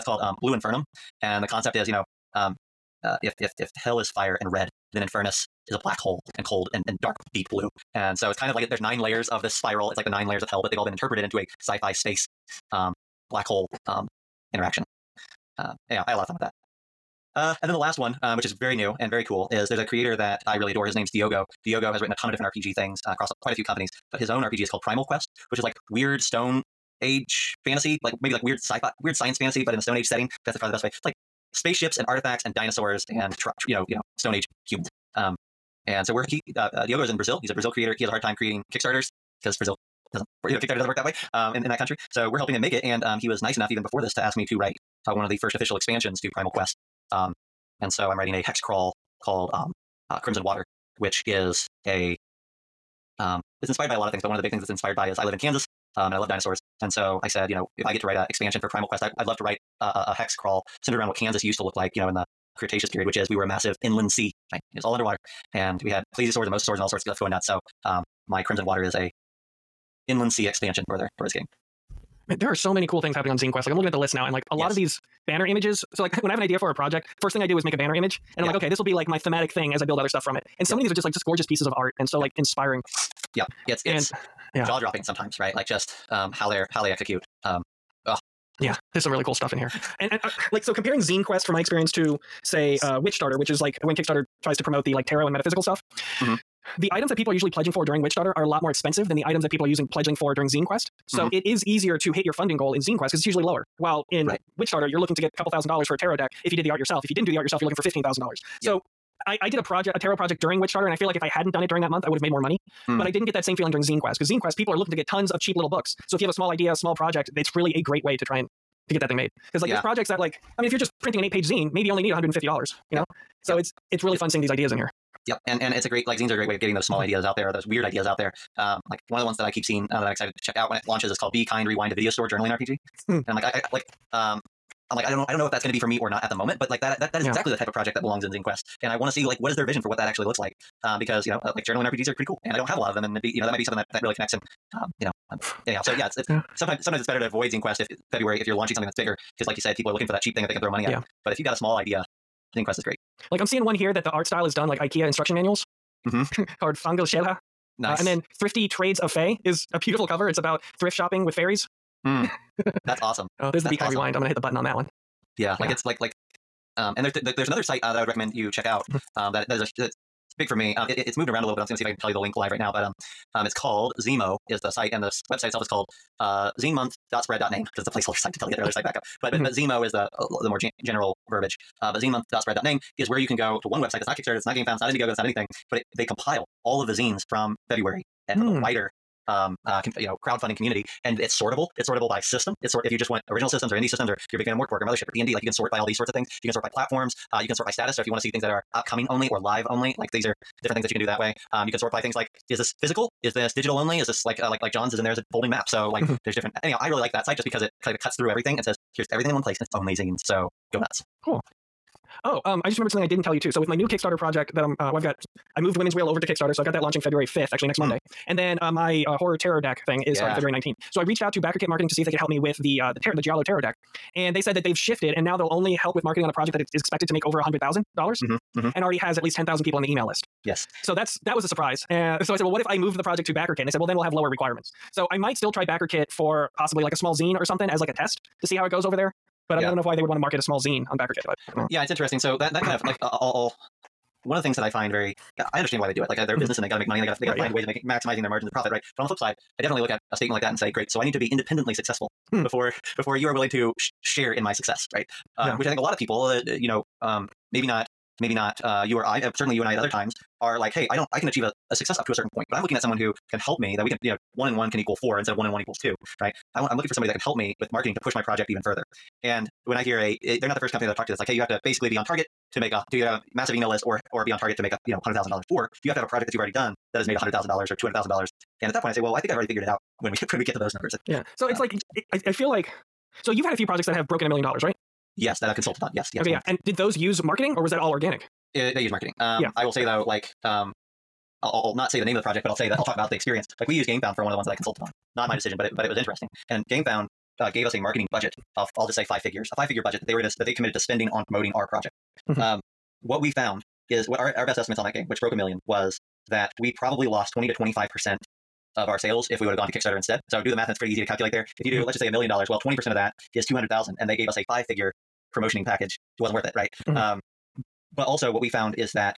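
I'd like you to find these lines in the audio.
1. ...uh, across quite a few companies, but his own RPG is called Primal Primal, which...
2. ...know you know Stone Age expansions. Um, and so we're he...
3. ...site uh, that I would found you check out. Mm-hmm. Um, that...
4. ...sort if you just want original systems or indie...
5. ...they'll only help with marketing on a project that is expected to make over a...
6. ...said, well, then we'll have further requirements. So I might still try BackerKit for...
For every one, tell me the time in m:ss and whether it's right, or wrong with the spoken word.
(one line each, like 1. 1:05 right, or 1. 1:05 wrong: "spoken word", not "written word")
1. 0:23 wrong: "Quest", not "Primal"
2. 0:33 wrong: "humans", not "expansions"
3. 2:47 wrong: "recommend", not "found"
4. 3:12 right
5. 3:45 right
6. 3:53 wrong: "lower", not "further".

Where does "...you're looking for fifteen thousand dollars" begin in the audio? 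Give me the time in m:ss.
1:47.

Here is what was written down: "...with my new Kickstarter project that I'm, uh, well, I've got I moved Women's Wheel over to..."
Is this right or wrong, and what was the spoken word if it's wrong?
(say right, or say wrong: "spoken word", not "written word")
right.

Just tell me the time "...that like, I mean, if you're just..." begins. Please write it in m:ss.
2:00.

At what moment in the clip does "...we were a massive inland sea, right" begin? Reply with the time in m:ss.
1:03.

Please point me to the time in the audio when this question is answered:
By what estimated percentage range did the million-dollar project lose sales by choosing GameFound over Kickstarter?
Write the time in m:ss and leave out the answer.
5:07.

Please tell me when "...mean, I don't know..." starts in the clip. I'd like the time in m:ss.
3:59.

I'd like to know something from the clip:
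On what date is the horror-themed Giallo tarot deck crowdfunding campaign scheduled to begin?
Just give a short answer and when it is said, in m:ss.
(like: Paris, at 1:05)
February 19, at 3:40.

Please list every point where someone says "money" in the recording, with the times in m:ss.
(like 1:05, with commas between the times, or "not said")
1:52, 2:30, 4:06.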